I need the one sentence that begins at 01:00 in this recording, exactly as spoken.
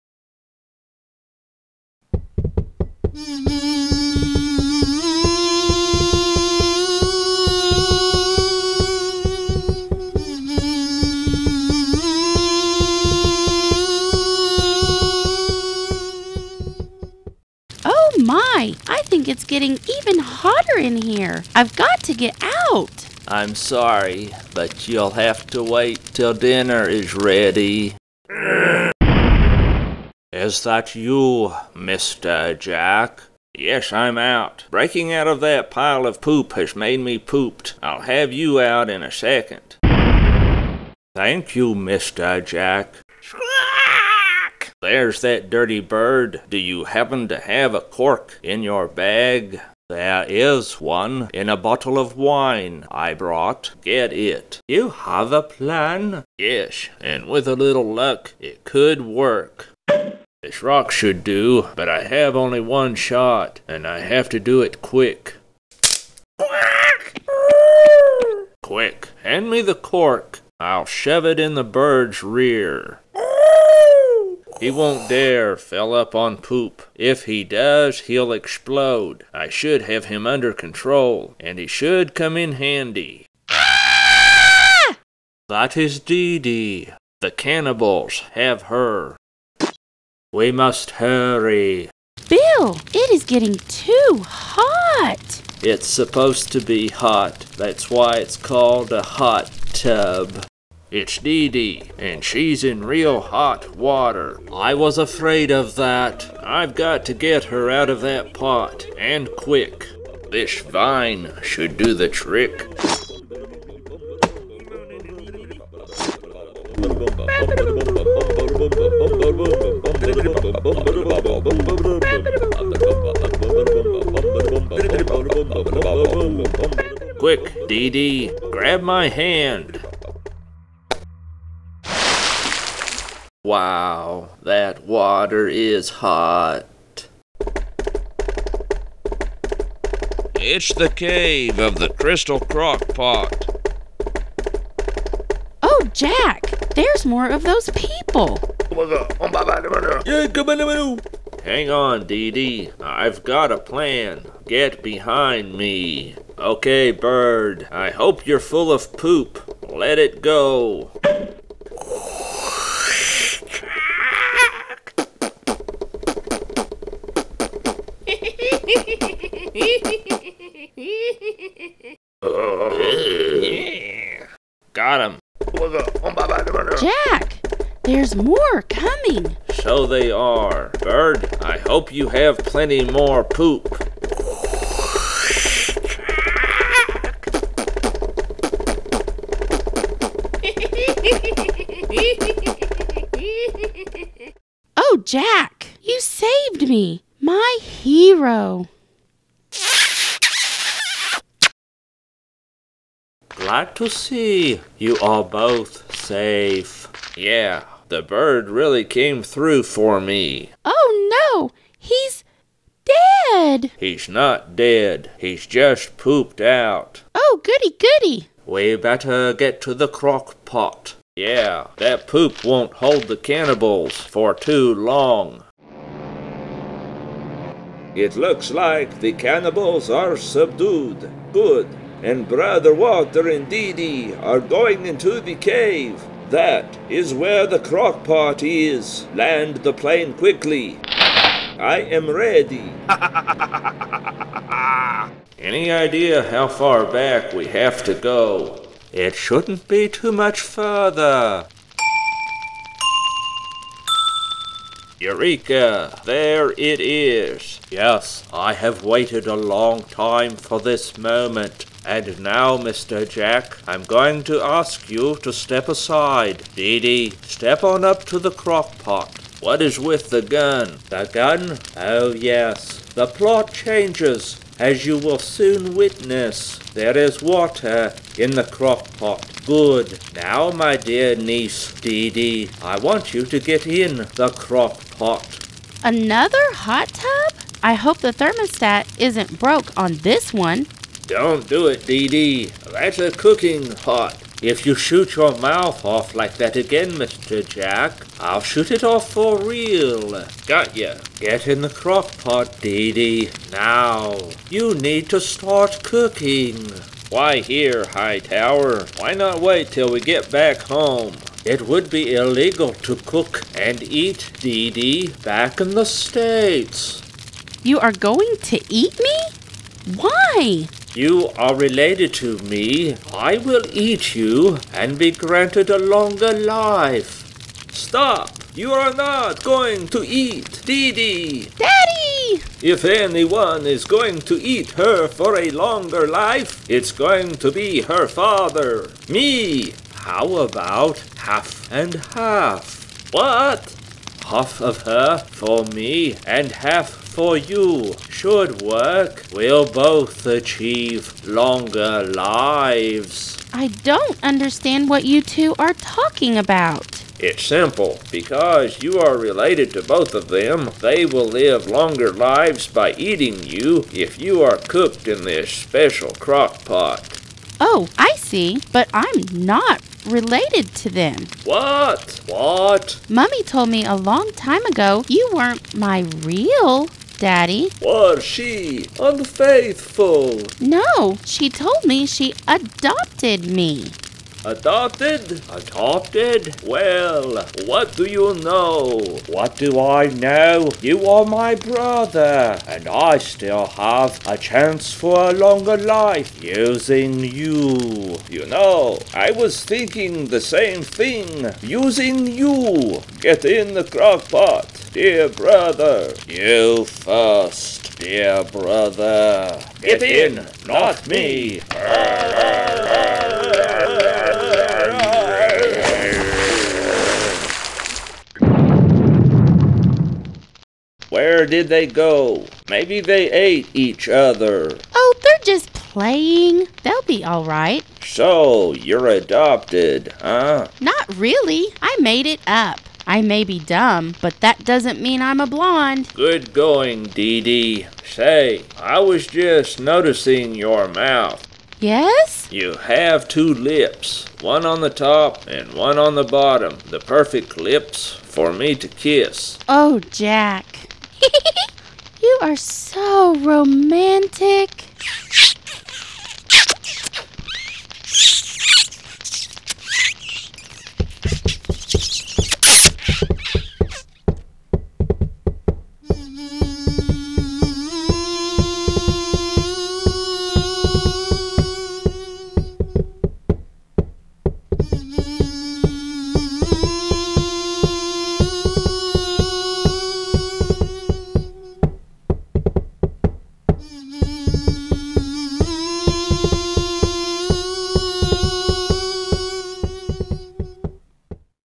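This rock should do, but I have only one shot, and I have to do it quick.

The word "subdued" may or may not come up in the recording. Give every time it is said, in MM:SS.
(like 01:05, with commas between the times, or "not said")
03:50.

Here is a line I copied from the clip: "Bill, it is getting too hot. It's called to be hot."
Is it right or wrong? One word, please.
wrong.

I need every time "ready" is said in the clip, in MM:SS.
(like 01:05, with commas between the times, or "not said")
00:27, 04:02.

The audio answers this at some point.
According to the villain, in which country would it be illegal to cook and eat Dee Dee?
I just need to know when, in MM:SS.
05:15.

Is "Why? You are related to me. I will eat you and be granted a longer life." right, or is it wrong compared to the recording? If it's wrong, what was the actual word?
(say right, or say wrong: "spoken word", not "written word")
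right.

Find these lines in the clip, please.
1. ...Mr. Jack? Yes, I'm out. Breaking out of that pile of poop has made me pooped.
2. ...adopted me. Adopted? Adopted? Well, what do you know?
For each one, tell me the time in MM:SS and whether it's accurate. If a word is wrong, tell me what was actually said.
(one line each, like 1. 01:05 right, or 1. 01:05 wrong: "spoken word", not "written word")
1. 00:31 right
2. 06:22 right.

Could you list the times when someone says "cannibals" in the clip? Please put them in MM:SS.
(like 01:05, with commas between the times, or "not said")
01:27, 03:43, 03:49.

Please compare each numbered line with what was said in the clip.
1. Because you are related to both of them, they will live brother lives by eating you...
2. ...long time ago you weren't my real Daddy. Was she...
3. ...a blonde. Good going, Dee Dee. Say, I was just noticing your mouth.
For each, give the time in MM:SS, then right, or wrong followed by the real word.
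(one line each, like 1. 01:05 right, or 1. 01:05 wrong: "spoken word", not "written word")
1. 05:58 wrong: "longer", not "brother"
2. 06:13 right
3. 07:15 right.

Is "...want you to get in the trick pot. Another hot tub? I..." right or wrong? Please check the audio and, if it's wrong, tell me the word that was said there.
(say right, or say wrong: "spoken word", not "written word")
wrong: "crock", not "trick".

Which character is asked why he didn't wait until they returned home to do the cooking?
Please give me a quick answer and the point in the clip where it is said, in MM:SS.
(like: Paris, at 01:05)
Hightower, at 05:07.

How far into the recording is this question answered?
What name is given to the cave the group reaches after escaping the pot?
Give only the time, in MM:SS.
02:20.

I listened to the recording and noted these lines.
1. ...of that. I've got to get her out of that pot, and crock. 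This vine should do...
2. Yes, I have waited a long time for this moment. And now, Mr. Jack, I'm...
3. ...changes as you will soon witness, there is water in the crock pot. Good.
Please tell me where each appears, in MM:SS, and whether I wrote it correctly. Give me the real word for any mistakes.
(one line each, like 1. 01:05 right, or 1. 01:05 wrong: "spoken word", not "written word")
1. 01:45 wrong: "quick", not "crock"
2. 04:17 right
3. 04:33 right.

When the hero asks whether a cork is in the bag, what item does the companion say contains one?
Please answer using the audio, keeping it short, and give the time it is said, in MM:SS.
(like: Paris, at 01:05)
A bottle of wine, at 00:51.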